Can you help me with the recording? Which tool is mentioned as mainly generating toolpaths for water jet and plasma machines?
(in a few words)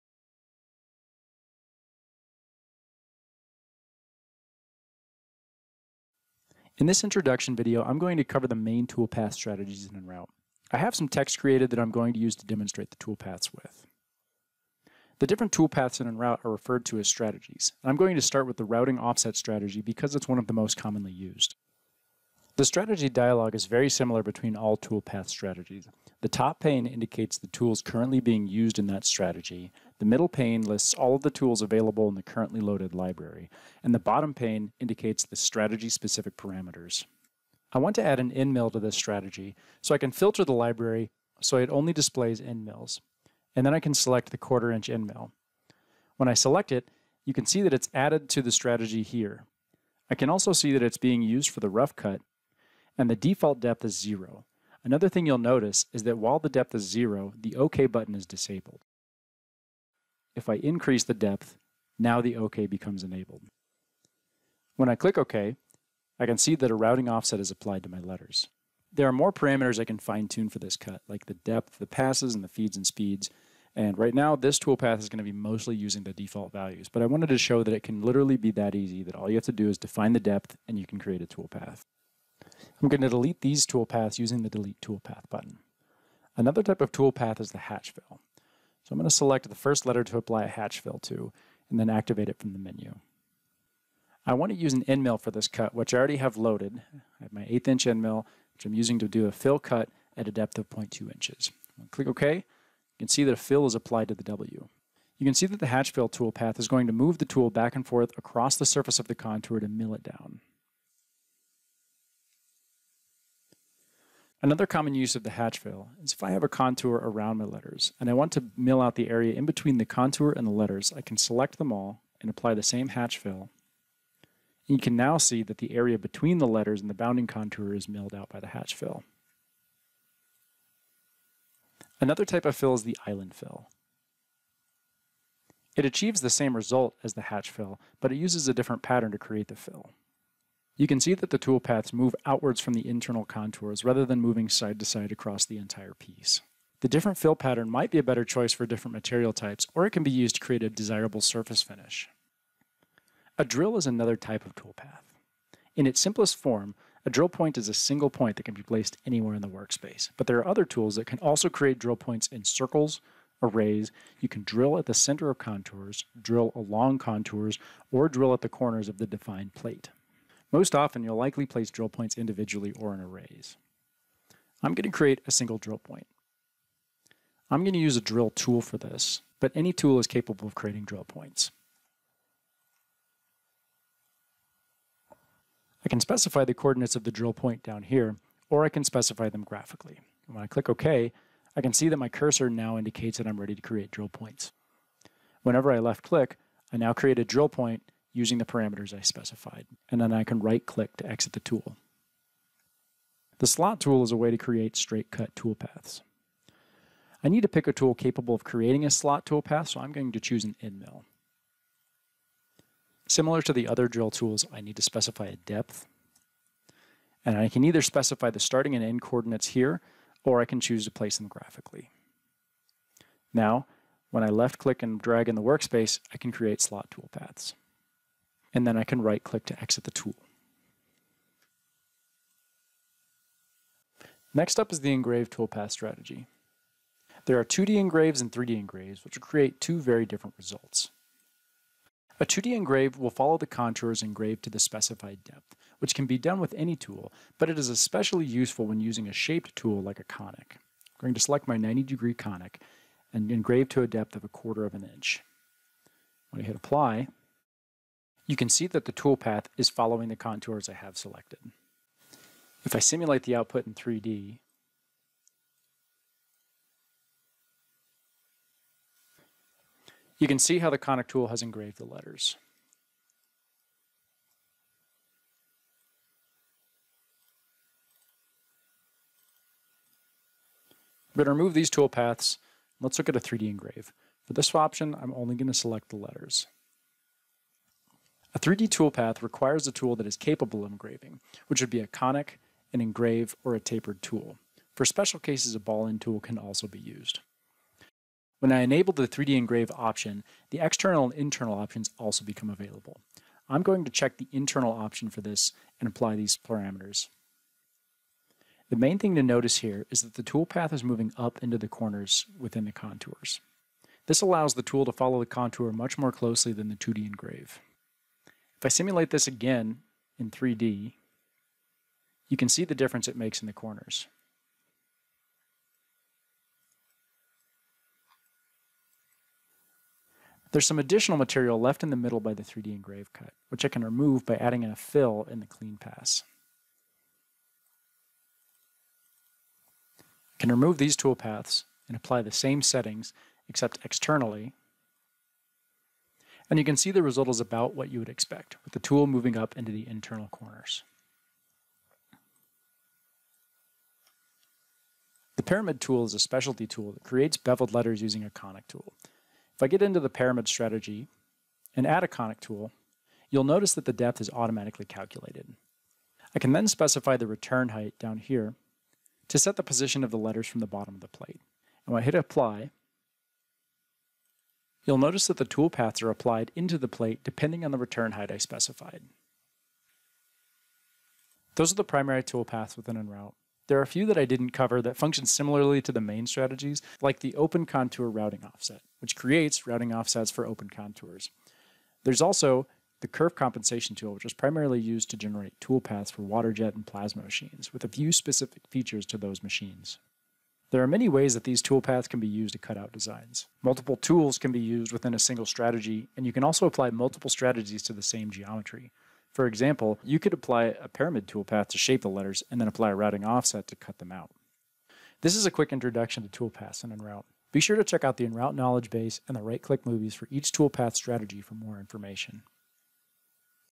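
curve compensation tool.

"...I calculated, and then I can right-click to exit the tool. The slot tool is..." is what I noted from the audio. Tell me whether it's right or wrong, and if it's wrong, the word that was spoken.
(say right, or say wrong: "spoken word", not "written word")
wrong: "specified", not "calculated".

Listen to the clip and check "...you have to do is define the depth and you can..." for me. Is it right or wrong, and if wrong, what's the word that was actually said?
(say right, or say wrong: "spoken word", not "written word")
right.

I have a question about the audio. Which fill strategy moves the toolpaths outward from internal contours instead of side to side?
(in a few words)
island fill.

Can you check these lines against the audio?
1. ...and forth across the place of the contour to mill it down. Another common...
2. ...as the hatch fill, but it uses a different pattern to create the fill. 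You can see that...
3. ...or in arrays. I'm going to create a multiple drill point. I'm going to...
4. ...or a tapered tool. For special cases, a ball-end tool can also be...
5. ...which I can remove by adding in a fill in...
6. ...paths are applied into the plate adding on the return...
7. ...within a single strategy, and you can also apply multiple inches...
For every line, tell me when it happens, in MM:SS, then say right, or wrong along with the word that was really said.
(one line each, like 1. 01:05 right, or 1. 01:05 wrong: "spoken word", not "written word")
1. 01:47 wrong: "surface", not "place"
2. 02:17 right
3. 02:52 wrong: "single", not "multiple"
4. 04:53 right
5. 05:33 right
6. 06:15 wrong: "depending", not "adding"
7. 06:44 wrong: "strategies", not "inches".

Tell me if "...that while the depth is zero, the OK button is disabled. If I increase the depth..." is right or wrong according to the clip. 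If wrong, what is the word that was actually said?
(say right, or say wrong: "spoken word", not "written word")
right.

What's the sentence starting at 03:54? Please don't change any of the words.
Next up is the engrave toolpath strategy.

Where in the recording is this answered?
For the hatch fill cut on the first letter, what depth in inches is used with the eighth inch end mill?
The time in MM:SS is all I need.
01:40.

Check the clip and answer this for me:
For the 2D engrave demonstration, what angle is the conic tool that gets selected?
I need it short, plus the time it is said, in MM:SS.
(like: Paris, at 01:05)
90 degree, at 04:11.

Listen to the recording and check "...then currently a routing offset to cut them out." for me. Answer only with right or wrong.
wrong.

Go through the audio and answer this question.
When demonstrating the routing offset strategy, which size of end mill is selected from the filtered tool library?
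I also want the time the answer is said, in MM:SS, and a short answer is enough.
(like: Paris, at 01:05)
quarter-inch, at 00:44.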